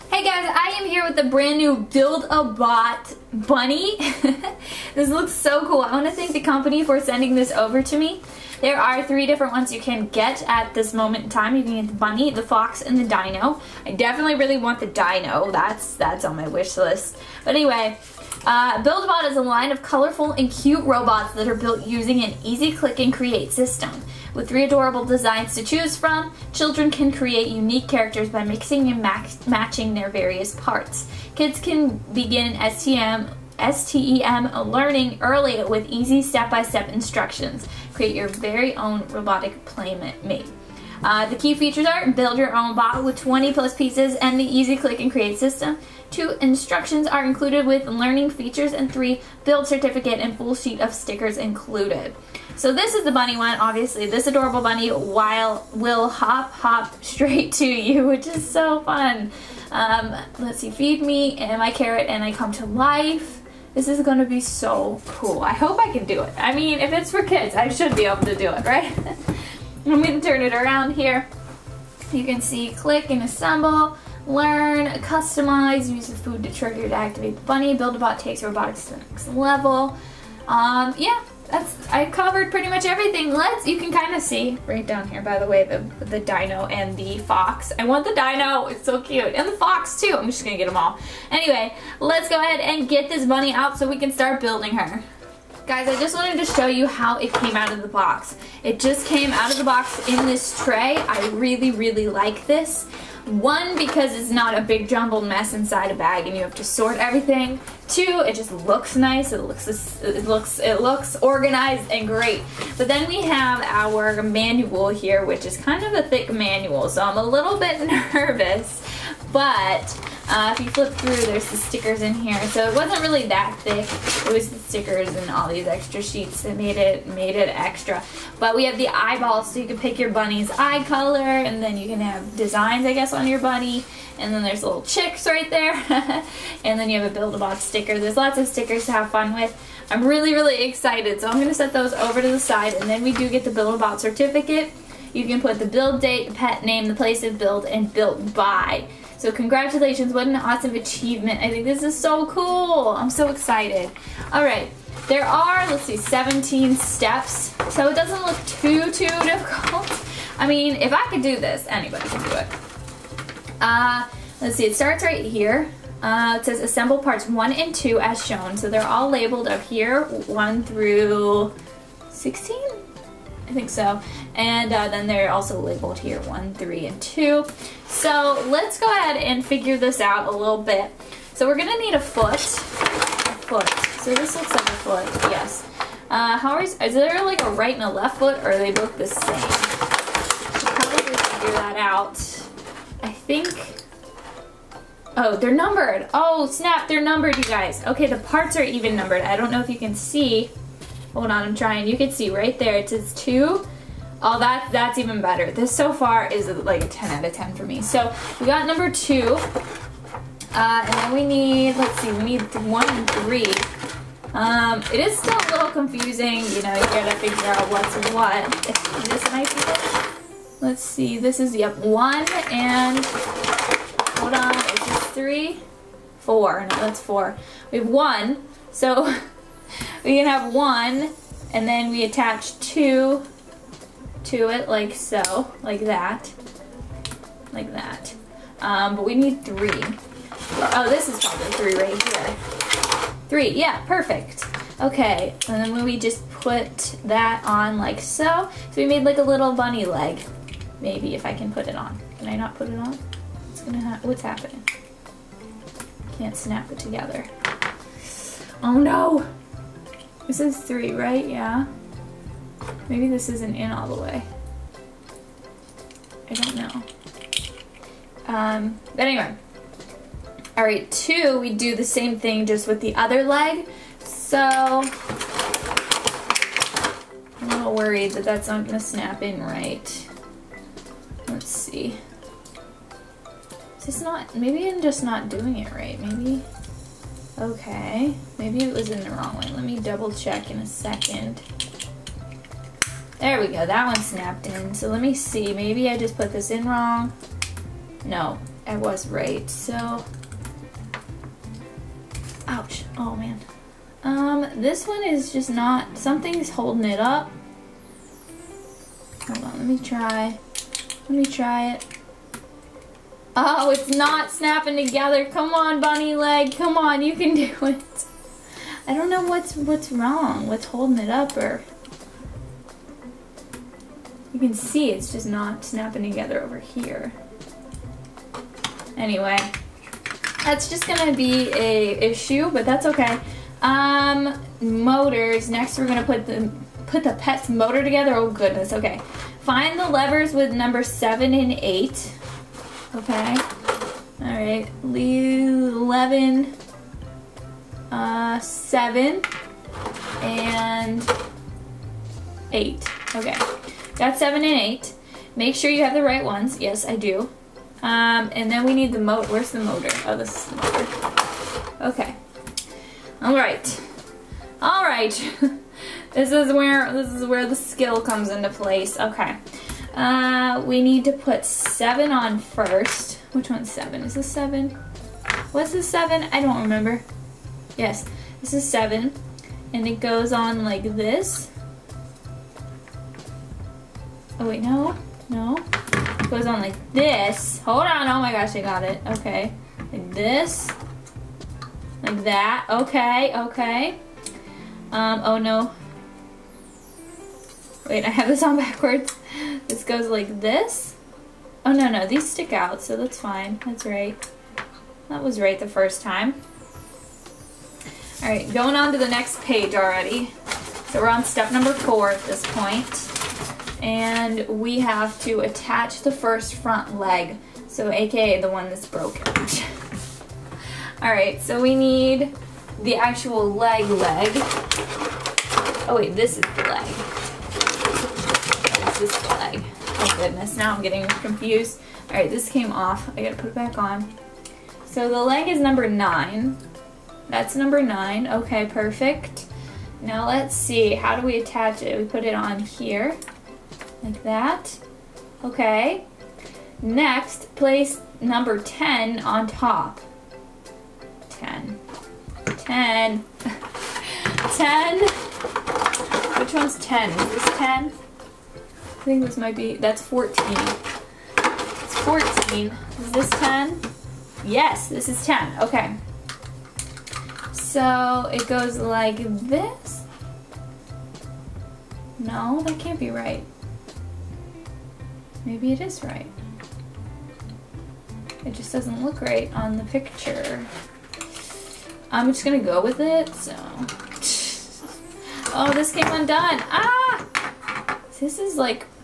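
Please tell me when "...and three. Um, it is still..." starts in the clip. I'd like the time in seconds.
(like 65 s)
212 s.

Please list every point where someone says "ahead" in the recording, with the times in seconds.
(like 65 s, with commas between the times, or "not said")
92 s, 178 s.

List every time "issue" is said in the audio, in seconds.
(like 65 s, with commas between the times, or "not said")
332 s.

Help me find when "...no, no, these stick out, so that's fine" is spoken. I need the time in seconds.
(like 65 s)
401 s.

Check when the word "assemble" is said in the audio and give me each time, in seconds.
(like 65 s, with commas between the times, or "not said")
73 s, 166 s.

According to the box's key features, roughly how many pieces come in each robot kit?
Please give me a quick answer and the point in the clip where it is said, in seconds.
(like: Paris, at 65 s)
20 plus, at 43 s.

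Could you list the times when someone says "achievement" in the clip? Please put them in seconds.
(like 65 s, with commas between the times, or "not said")
150 s.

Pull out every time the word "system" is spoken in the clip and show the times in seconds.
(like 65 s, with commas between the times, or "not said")
23 s, 45 s.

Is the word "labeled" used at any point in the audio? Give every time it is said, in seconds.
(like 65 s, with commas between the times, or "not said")
169 s, 175 s.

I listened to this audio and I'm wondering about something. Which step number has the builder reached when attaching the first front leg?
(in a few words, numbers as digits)
4.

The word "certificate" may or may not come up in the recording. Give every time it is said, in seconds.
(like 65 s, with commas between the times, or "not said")
49 s, 144 s.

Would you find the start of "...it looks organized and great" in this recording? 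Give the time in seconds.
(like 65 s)
110 s.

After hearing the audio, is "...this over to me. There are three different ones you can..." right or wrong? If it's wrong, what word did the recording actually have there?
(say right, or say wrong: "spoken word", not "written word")
right.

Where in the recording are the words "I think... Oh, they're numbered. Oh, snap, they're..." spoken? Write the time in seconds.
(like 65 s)
193 s.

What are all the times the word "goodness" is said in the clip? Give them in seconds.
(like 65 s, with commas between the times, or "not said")
338 s, 430 s.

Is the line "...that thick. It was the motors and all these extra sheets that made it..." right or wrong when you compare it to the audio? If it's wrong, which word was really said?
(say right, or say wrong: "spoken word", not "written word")
wrong: "stickers", not "motors".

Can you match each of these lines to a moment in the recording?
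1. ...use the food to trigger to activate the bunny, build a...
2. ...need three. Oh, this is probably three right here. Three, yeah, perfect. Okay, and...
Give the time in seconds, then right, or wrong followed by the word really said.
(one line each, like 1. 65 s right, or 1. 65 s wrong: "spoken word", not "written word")
1. 75 s right
2. 239 s right.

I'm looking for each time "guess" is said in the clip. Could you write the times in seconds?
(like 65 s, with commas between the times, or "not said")
132 s.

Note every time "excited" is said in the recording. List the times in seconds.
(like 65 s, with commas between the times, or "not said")
140 s, 153 s.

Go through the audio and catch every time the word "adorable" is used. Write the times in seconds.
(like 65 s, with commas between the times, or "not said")
24 s, 54 s.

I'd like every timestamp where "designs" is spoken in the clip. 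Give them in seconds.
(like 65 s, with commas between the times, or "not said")
25 s, 132 s.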